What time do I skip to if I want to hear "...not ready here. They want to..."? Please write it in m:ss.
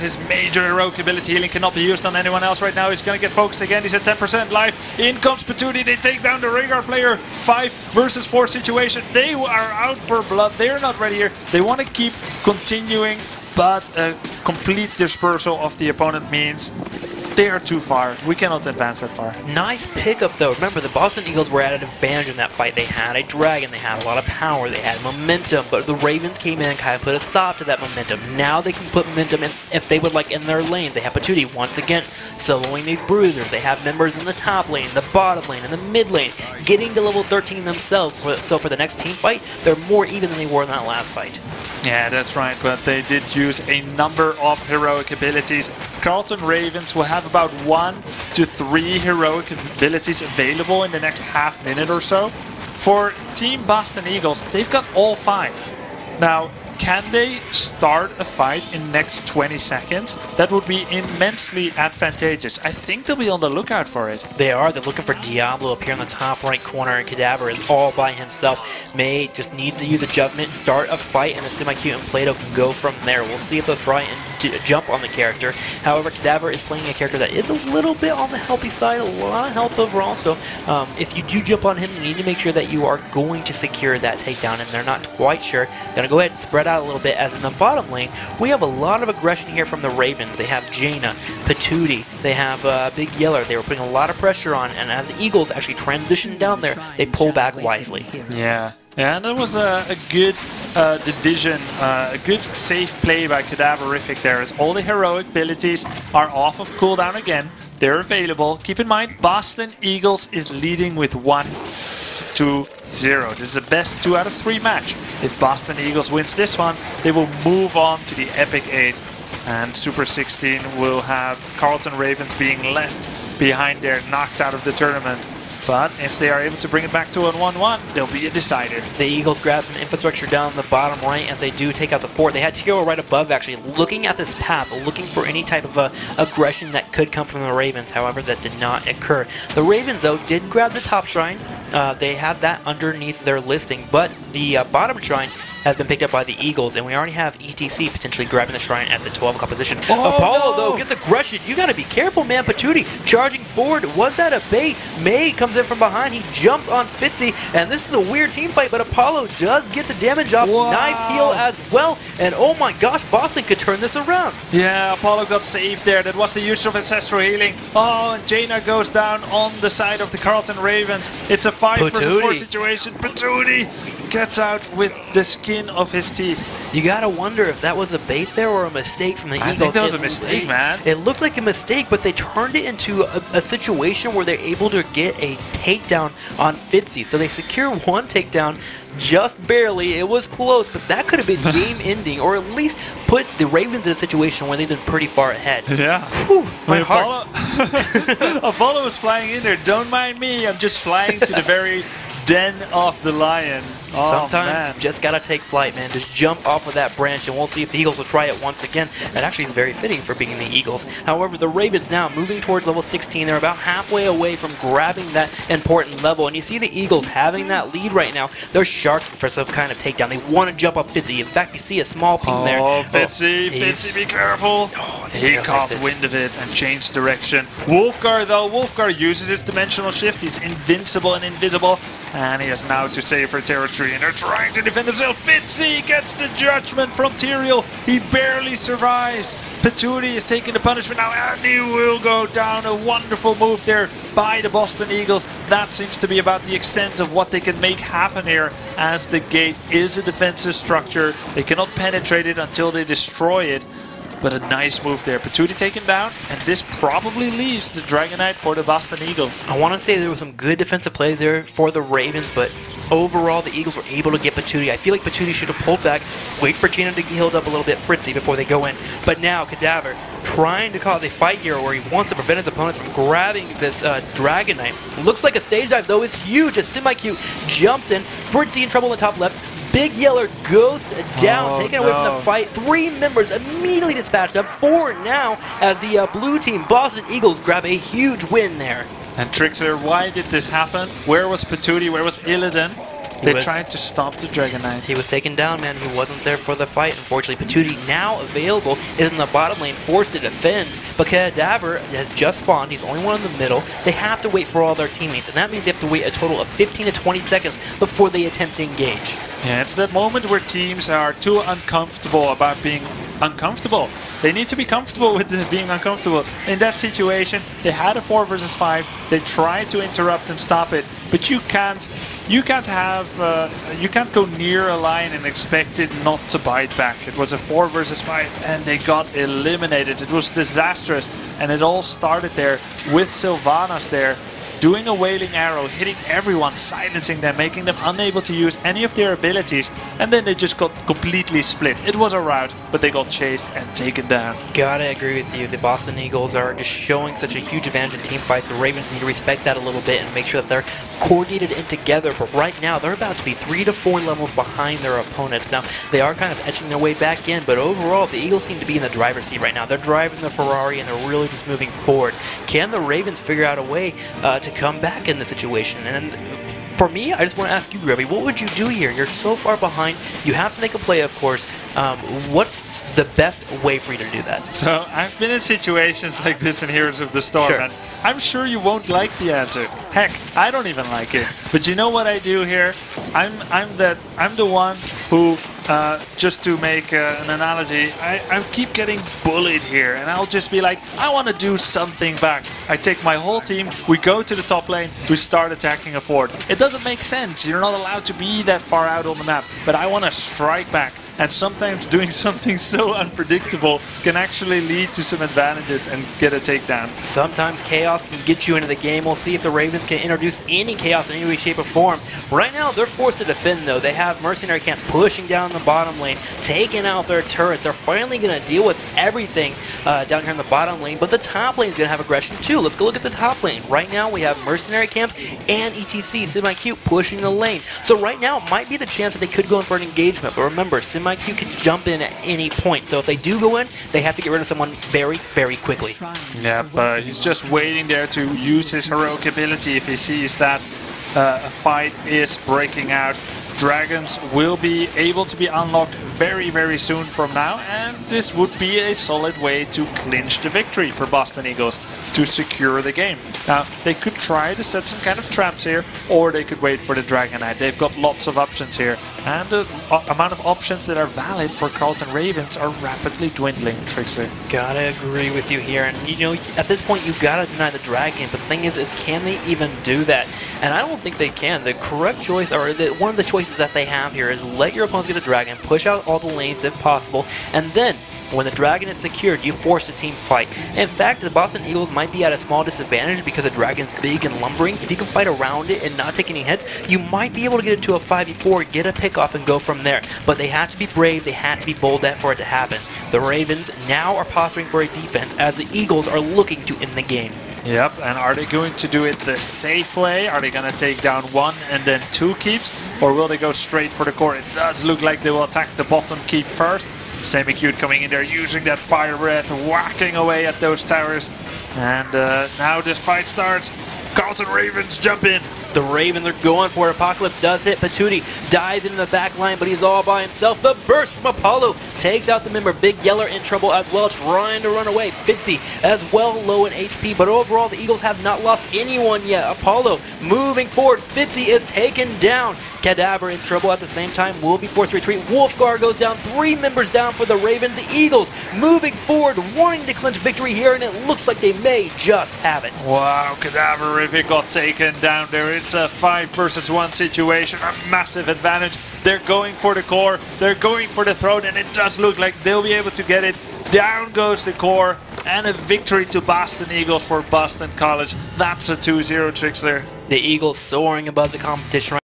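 0:10.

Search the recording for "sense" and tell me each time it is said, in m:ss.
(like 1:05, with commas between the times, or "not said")
6:37.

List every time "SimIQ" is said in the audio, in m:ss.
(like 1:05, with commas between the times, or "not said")
7:06, 7:10.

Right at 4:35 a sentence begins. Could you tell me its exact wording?
Looks like a stage dive, though, is huge A semi queue jumps in.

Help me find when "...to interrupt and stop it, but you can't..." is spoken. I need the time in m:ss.
5:19.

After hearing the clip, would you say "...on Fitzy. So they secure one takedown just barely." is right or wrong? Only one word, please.
right.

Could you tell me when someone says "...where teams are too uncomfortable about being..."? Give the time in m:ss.
5:10.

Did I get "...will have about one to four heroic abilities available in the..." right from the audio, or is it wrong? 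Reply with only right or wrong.
wrong.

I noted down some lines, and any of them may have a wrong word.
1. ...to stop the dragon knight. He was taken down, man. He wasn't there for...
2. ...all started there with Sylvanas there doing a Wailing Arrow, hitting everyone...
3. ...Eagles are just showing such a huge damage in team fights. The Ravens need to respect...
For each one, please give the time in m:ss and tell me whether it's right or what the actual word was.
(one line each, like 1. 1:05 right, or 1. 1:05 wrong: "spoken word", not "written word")
1. 4:53 right
2. 5:31 right
3. 5:45 wrong: "advantage", not "damage".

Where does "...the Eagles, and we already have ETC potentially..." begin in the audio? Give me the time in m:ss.
2:26.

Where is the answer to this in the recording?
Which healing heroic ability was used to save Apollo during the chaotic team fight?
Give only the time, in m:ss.
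2:46.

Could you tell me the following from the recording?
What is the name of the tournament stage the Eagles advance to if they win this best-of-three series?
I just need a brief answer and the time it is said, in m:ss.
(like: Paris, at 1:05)
Epic 8, at 1:58.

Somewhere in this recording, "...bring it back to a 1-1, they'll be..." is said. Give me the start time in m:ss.
2:06.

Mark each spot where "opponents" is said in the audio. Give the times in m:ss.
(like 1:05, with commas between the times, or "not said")
0:15, 4:32, 5:54, 7:54.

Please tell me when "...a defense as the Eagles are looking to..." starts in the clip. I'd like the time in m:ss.
8:14.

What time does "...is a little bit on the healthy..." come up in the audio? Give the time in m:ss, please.
1:17.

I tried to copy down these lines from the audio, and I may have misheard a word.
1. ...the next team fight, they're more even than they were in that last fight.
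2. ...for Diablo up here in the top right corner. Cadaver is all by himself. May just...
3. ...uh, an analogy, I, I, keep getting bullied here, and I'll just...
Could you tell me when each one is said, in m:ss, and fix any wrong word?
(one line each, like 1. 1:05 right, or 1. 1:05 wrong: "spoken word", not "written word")
1. 0:38 right
2. 1:05 right
3. 6:26 right.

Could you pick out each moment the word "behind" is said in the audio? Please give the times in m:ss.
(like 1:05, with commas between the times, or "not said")
2:03, 2:35, 5:54, 6:09.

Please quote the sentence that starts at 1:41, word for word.
Uh, a good safe play by Cadaverific there as all the heroic abilities are off of cooldown again.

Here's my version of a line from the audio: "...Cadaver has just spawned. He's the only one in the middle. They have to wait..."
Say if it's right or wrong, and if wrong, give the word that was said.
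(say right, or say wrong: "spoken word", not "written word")
right.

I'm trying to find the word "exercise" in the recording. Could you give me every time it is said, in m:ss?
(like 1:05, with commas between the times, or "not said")
not said.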